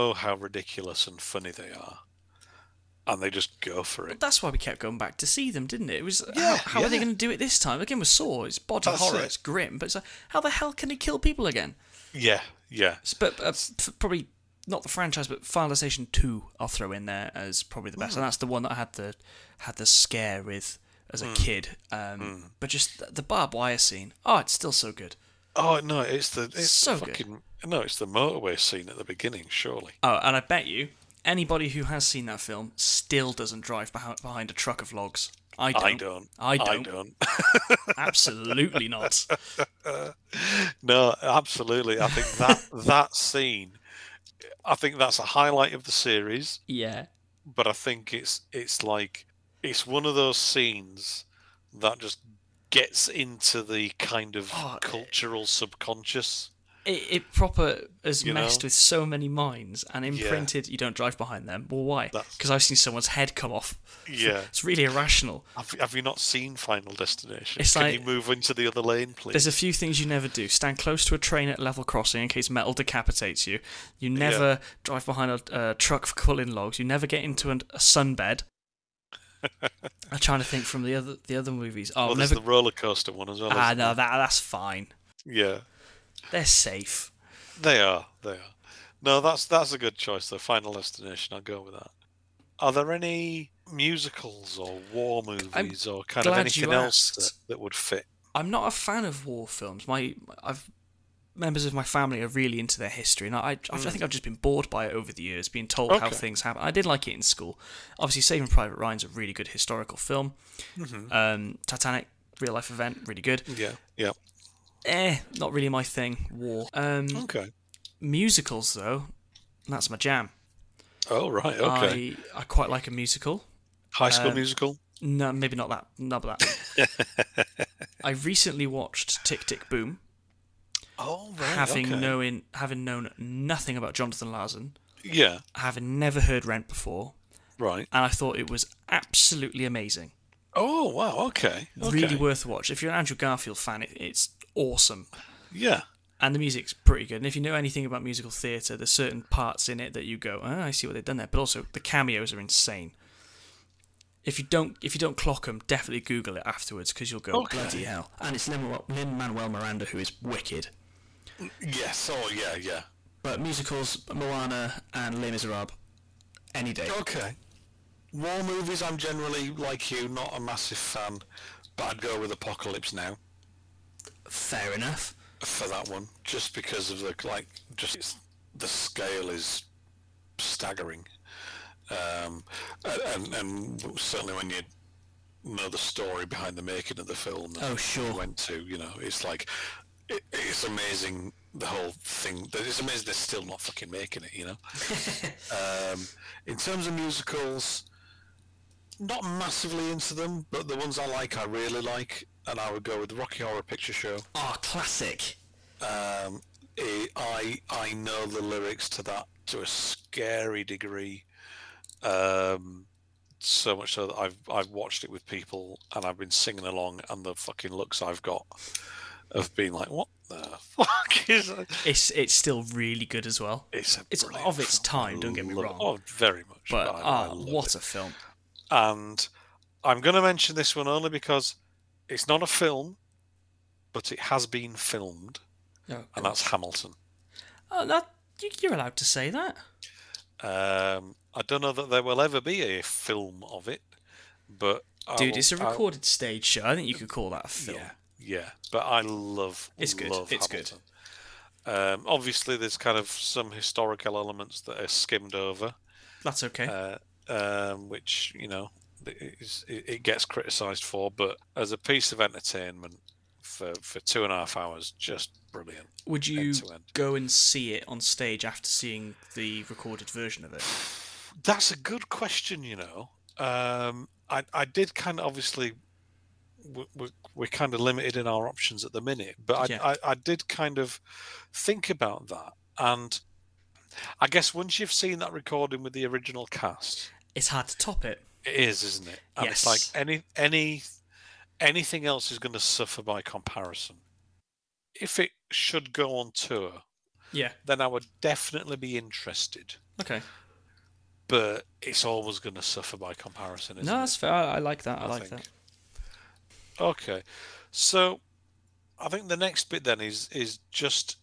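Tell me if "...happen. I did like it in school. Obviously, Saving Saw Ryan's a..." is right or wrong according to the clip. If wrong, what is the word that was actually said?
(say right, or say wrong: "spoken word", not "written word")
wrong: "Private", not "Saw".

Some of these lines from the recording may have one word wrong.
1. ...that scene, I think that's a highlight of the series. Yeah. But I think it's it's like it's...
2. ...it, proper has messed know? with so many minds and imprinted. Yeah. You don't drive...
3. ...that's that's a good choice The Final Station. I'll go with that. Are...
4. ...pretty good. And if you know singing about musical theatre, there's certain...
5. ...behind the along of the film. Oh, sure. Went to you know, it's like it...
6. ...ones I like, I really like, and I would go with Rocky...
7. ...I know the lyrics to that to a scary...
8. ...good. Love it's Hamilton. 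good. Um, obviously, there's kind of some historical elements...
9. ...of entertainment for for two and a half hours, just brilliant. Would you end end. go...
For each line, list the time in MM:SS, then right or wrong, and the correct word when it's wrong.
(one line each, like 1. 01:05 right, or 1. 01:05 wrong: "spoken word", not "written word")
1. 00:42 right
2. 00:57 right
3. 01:29 wrong: "Destination", not "Station"
4. 02:26 wrong: "anything", not "singing"
5. 03:06 wrong: "making", not "along"
6. 03:20 right
7. 03:27 right
8. 04:09 right
9. 04:22 right.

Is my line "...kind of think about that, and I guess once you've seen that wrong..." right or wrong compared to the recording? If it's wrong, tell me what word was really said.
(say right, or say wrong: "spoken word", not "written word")
wrong: "recording", not "wrong".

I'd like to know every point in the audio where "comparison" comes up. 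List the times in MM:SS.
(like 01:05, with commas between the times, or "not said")
04:53, 05:03.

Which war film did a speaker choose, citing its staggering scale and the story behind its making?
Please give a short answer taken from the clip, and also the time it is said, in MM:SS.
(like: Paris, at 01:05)
Apocalypse Now, at 02:52.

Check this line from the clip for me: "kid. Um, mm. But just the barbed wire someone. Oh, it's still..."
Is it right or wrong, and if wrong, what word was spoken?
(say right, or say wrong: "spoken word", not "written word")
wrong: "scene", not "someone".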